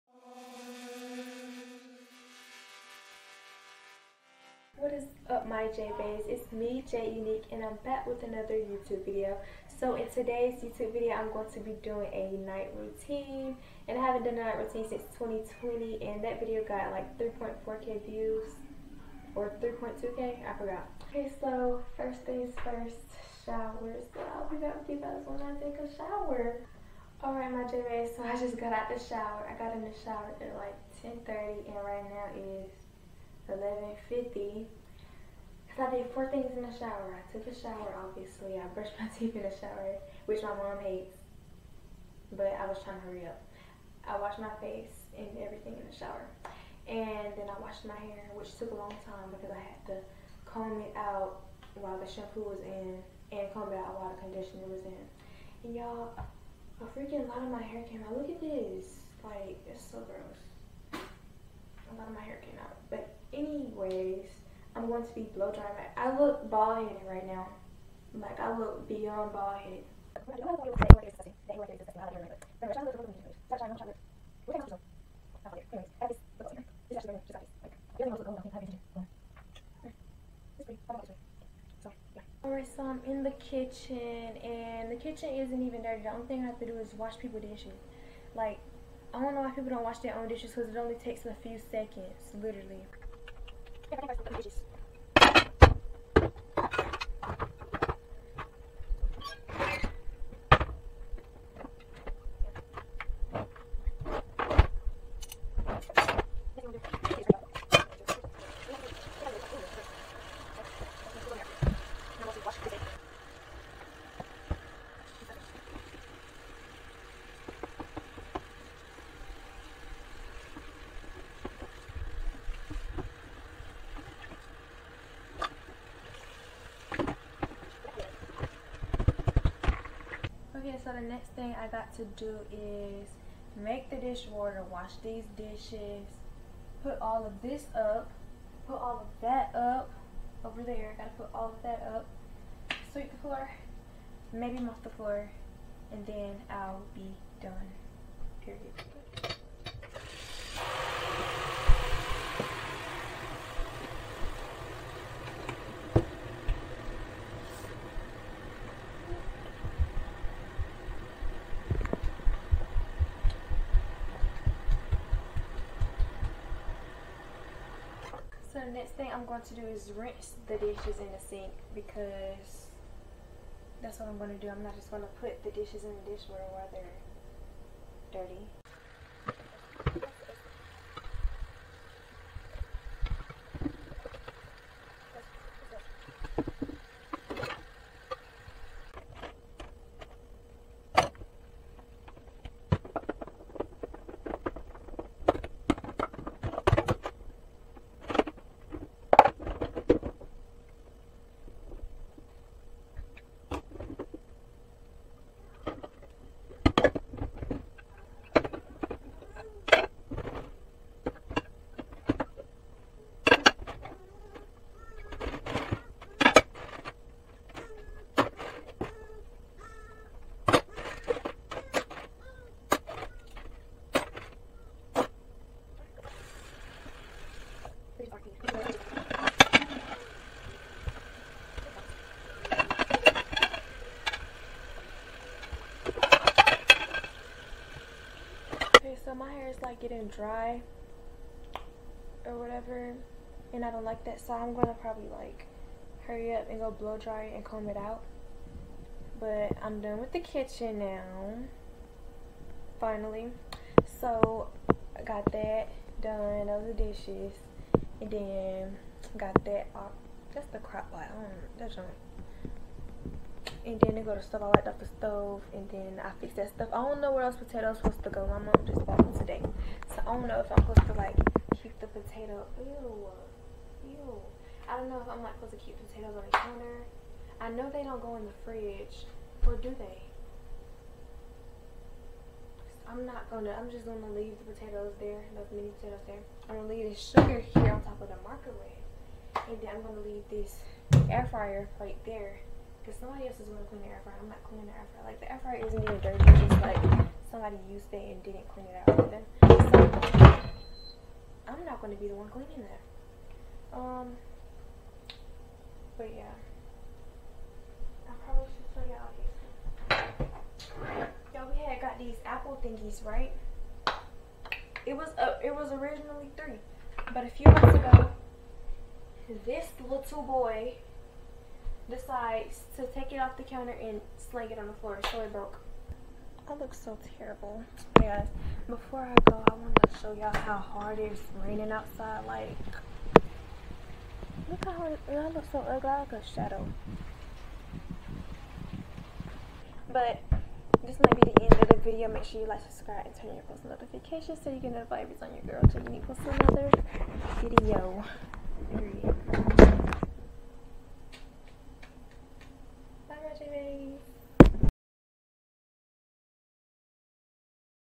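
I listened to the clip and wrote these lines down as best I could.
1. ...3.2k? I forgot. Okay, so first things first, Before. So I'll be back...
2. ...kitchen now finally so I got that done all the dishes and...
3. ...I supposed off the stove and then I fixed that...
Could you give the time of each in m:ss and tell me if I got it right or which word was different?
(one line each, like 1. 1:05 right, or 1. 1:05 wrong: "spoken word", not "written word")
1. 0:19 wrong: "Showers", not "Before"
2. 4:10 right
3. 4:24 wrong: "wiped", not "supposed".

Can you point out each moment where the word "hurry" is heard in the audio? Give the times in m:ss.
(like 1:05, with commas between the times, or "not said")
0:43, 4:06.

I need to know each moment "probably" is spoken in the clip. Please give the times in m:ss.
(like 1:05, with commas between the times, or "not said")
4:04, 5:08.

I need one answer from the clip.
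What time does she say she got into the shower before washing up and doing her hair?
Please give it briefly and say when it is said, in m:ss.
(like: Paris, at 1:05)
10:30, at 0:31.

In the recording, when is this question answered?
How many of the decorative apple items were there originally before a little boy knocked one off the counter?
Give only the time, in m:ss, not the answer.
5:16.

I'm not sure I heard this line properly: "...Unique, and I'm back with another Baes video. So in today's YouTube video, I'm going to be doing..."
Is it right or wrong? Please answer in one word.
wrong.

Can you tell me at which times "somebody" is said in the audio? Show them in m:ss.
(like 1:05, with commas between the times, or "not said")
4:52, 4:57.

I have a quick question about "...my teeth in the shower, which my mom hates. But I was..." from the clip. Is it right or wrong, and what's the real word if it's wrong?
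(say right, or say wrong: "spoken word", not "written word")
right.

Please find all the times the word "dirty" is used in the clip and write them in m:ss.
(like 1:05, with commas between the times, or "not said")
1:25, 2:58, 4:56.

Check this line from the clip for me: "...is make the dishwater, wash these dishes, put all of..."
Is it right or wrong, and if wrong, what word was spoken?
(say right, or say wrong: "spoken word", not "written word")
right.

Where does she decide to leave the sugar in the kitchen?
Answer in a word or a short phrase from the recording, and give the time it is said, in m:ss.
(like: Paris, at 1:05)
on top of the microwave, at 4:47.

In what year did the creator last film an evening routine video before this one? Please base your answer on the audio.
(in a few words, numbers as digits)
2020.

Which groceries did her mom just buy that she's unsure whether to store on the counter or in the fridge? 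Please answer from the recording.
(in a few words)
mini potatoes.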